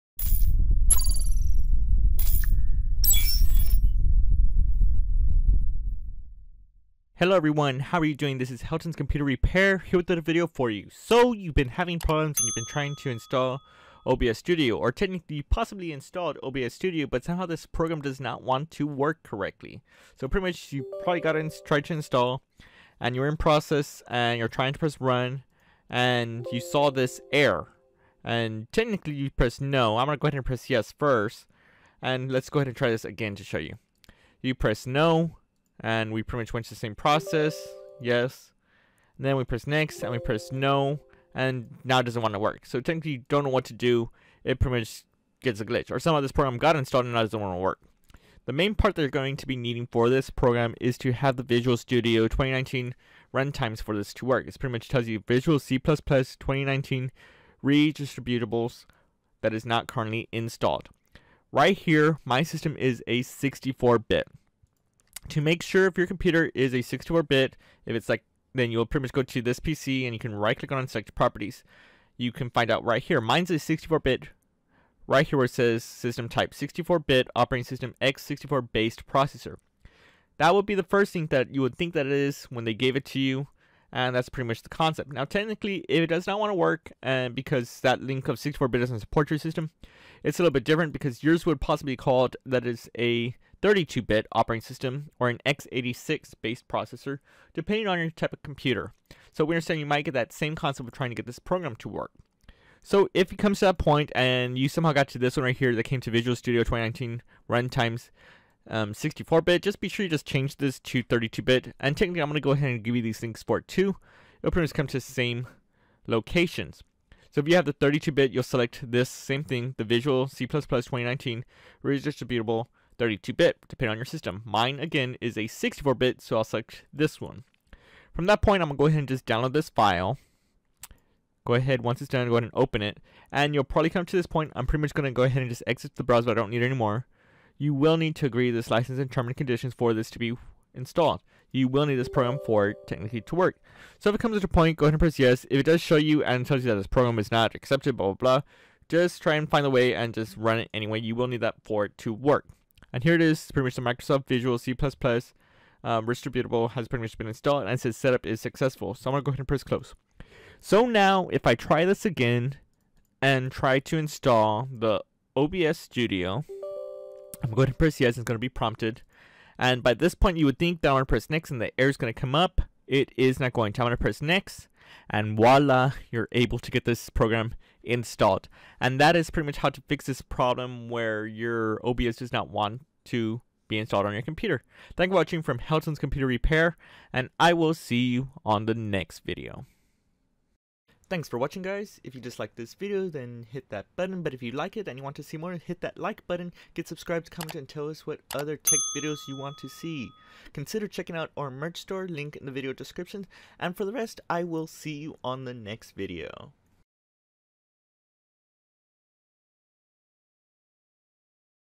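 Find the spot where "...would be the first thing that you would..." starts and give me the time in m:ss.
1:20.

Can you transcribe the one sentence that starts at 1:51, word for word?
And technically, I'm going to go ahead and give you these things for it too.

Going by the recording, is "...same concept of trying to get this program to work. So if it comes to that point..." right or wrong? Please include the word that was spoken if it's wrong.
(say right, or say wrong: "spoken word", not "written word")
right.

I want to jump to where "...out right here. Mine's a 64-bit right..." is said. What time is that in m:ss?
1:12.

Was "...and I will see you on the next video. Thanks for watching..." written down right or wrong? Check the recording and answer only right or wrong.
right.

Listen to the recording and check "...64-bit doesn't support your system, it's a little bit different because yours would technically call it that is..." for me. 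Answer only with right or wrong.
wrong.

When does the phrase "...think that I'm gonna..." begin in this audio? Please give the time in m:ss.
2:50.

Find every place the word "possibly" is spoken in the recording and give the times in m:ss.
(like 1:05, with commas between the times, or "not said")
0:15, 1:31.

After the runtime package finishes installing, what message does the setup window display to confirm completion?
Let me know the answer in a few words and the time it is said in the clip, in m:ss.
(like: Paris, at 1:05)
setup is successful, at 2:37.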